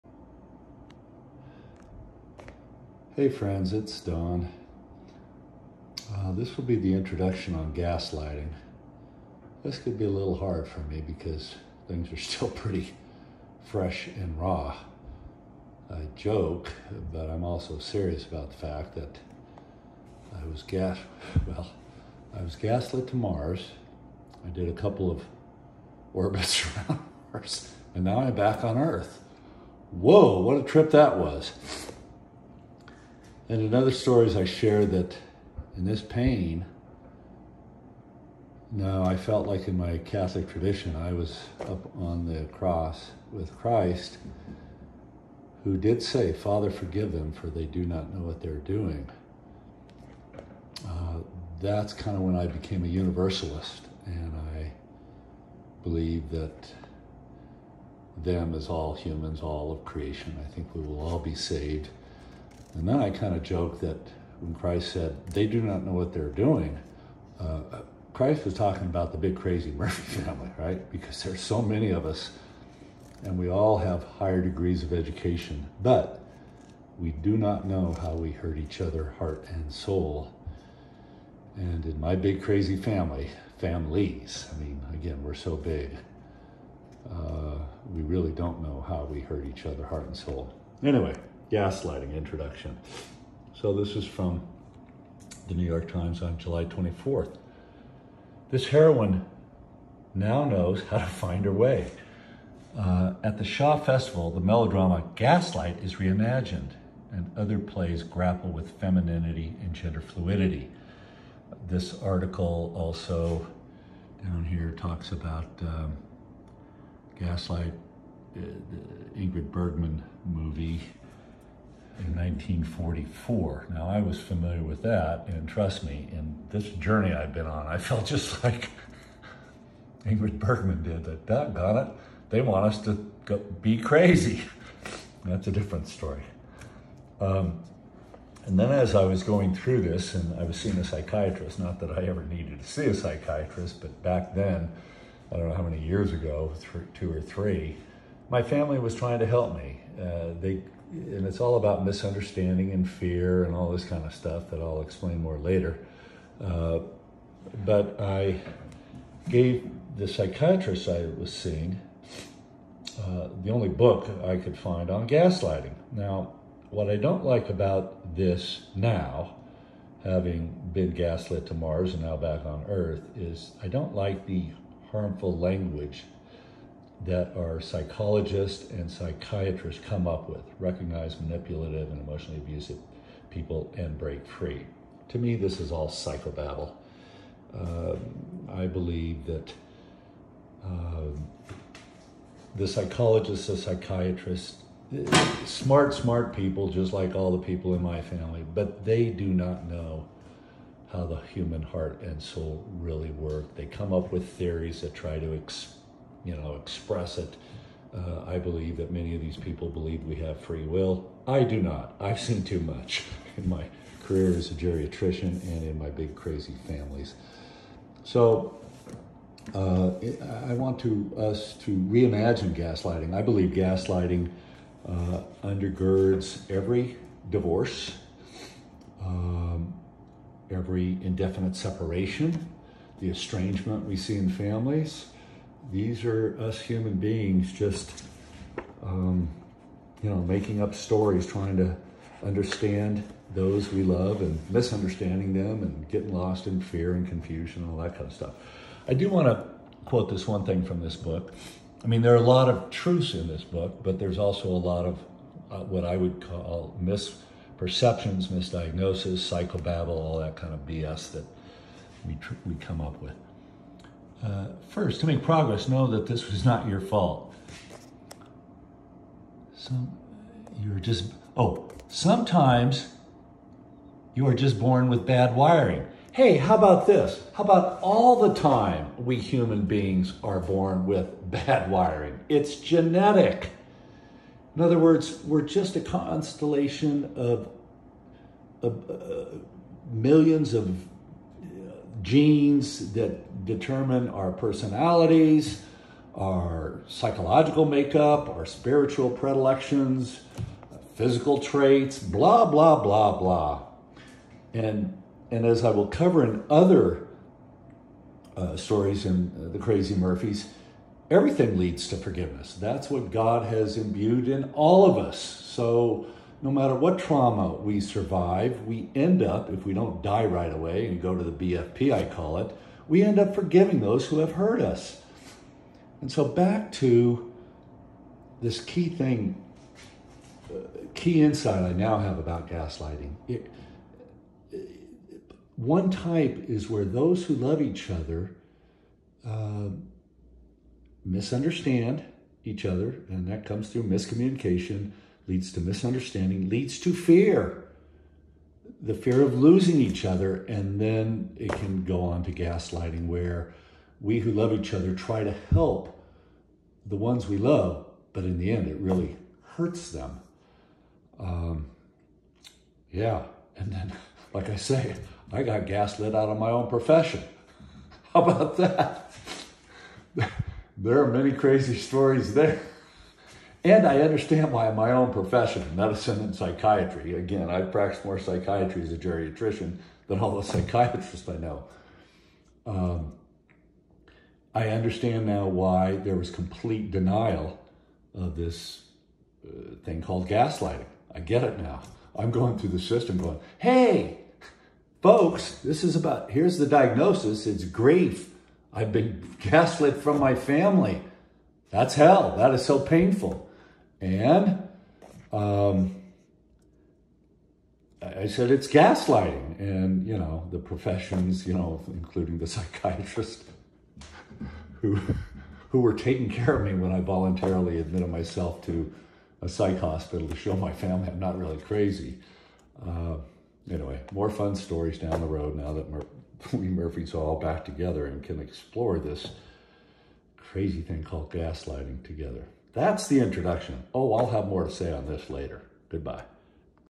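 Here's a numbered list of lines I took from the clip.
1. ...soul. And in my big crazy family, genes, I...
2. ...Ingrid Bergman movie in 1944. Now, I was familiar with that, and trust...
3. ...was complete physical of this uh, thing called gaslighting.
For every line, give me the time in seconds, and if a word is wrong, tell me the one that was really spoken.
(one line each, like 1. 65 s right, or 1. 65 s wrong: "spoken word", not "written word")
1. 79 s wrong: "families", not "genes"
2. 119 s right
3. 386 s wrong: "denial", not "physical".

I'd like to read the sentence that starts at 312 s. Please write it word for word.
That's what God has imbued in all of us.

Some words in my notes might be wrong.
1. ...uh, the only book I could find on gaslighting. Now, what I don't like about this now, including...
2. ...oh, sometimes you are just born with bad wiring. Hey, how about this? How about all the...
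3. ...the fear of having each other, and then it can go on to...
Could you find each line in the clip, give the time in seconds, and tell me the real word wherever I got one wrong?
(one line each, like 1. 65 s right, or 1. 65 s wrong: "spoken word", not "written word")
1. 163 s wrong: "having", not "including"
2. 271 s right
3. 348 s wrong: "losing", not "having".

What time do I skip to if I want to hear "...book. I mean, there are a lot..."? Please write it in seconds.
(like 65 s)
250 s.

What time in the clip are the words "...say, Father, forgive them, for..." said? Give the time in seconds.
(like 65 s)
46 s.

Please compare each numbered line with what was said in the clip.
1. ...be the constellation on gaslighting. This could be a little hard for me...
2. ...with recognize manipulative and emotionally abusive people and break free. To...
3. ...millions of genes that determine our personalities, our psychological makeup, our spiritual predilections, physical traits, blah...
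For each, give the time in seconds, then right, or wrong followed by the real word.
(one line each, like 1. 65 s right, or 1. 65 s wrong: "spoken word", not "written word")
1. 6 s wrong: "introduction", not "constellation"
2. 180 s right
3. 289 s right.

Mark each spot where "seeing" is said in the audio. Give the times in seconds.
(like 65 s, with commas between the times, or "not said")
140 s, 161 s.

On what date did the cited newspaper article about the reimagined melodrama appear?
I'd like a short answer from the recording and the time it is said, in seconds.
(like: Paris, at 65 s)
July 24th, at 96 s.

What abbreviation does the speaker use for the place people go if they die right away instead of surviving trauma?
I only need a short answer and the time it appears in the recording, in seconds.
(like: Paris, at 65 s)
BFP, at 321 s.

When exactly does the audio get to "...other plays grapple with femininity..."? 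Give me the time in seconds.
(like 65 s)
107 s.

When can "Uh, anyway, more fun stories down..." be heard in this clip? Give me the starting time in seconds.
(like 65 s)
422 s.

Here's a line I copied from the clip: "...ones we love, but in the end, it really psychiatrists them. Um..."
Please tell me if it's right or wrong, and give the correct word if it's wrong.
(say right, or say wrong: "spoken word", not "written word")
wrong: "hurts", not "psychiatrists".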